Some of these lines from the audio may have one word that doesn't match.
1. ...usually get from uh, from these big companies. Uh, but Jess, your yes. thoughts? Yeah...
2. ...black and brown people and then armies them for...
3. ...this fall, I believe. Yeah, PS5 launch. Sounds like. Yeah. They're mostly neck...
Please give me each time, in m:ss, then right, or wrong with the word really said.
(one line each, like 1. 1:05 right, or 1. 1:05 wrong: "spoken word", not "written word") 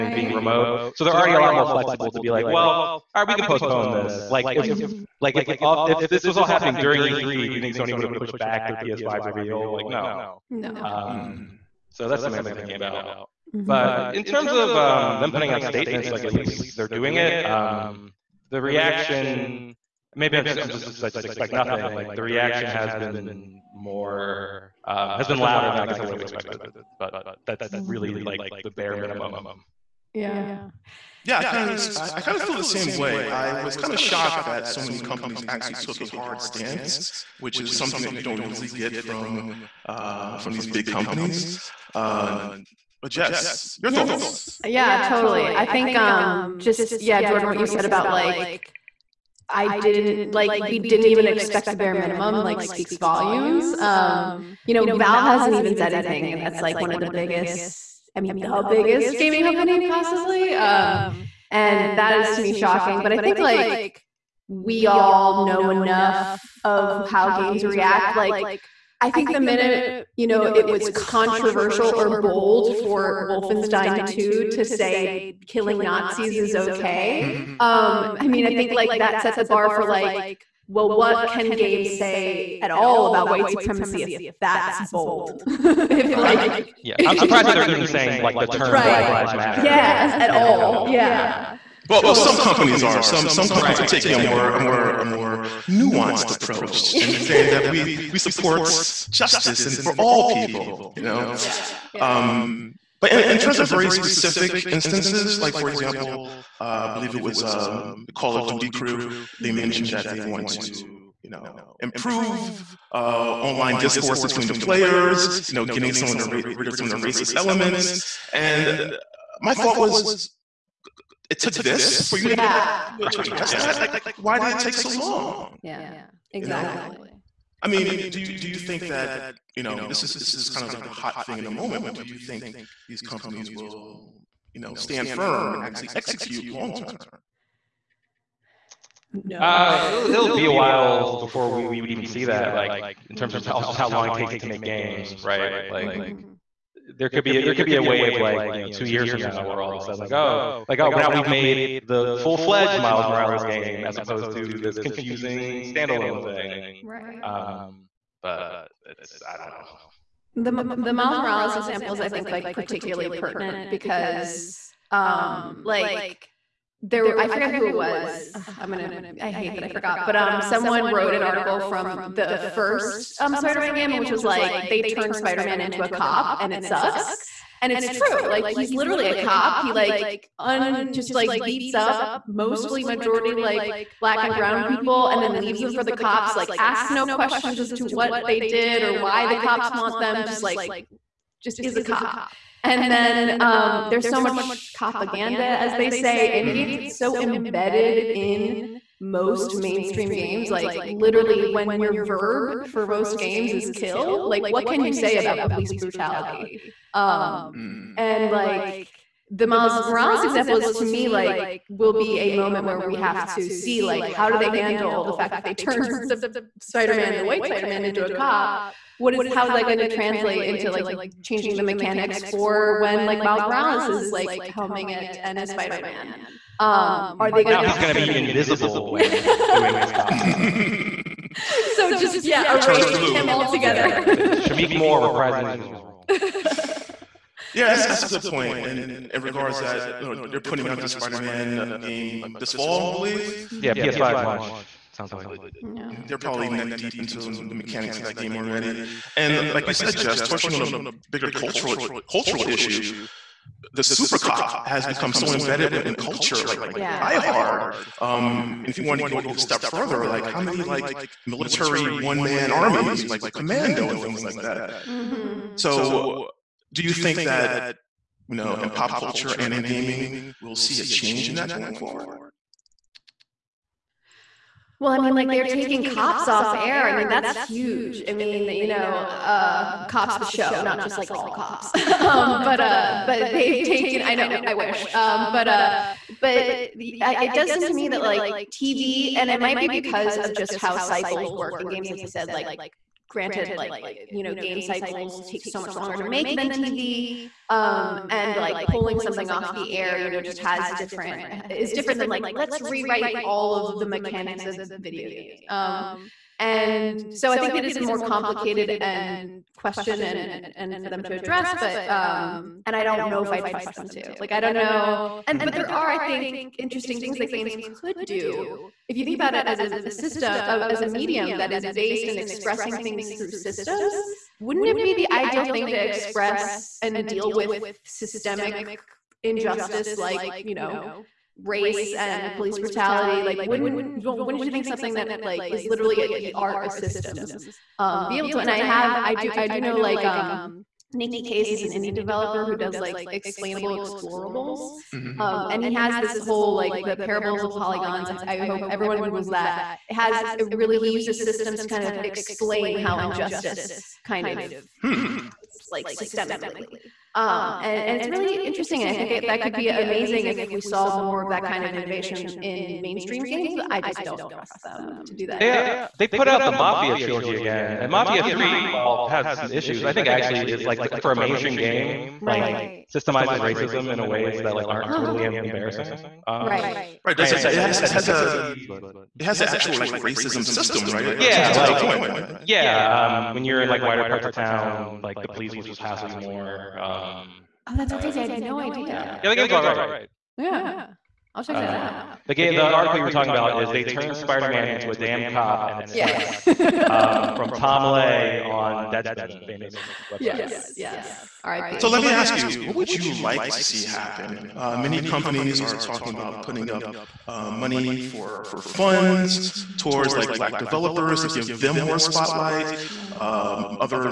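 1. 0:38 right
2. 3:03 wrong: "leaves", not "armies"
3. 4:02 wrong: "probably", not "mostly".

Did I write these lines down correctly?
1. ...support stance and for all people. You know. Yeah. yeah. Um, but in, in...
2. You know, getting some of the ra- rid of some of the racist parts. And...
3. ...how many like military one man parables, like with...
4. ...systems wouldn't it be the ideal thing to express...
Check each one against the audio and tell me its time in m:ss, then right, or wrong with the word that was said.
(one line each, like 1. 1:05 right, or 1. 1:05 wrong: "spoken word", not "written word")
1. 1:38 wrong: "justice", not "stance"
2. 1:55 wrong: "elements", not "parts"
3. 4:20 wrong: "armies", not "parables"
4. 5:23 right.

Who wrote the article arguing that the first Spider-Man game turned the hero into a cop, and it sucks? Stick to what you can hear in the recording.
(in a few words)
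Tom Ley.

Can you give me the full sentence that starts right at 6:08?
3 well has some issues i think actually is like for a mainstream game right.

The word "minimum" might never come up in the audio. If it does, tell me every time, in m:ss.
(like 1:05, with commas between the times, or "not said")
0:28, 0:51.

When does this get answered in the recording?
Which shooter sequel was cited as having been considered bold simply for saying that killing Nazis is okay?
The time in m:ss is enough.
1:13.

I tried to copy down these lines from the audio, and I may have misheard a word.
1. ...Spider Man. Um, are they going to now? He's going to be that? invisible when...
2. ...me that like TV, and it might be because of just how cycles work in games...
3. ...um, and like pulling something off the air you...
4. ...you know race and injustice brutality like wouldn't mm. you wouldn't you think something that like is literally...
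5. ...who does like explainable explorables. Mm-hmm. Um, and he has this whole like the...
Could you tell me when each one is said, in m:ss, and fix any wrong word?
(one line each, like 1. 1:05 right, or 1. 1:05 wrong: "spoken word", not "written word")
1. 3:45 right
2. 4:47 right
3. 4:57 right
4. 5:30 wrong: "police", not "injustice"
5. 5:42 right.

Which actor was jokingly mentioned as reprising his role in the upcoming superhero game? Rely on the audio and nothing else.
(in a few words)
Shameik Moore.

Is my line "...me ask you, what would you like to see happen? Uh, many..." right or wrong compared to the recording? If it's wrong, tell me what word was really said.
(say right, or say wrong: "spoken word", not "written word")
right.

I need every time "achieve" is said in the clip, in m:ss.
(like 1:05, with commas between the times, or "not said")
not said.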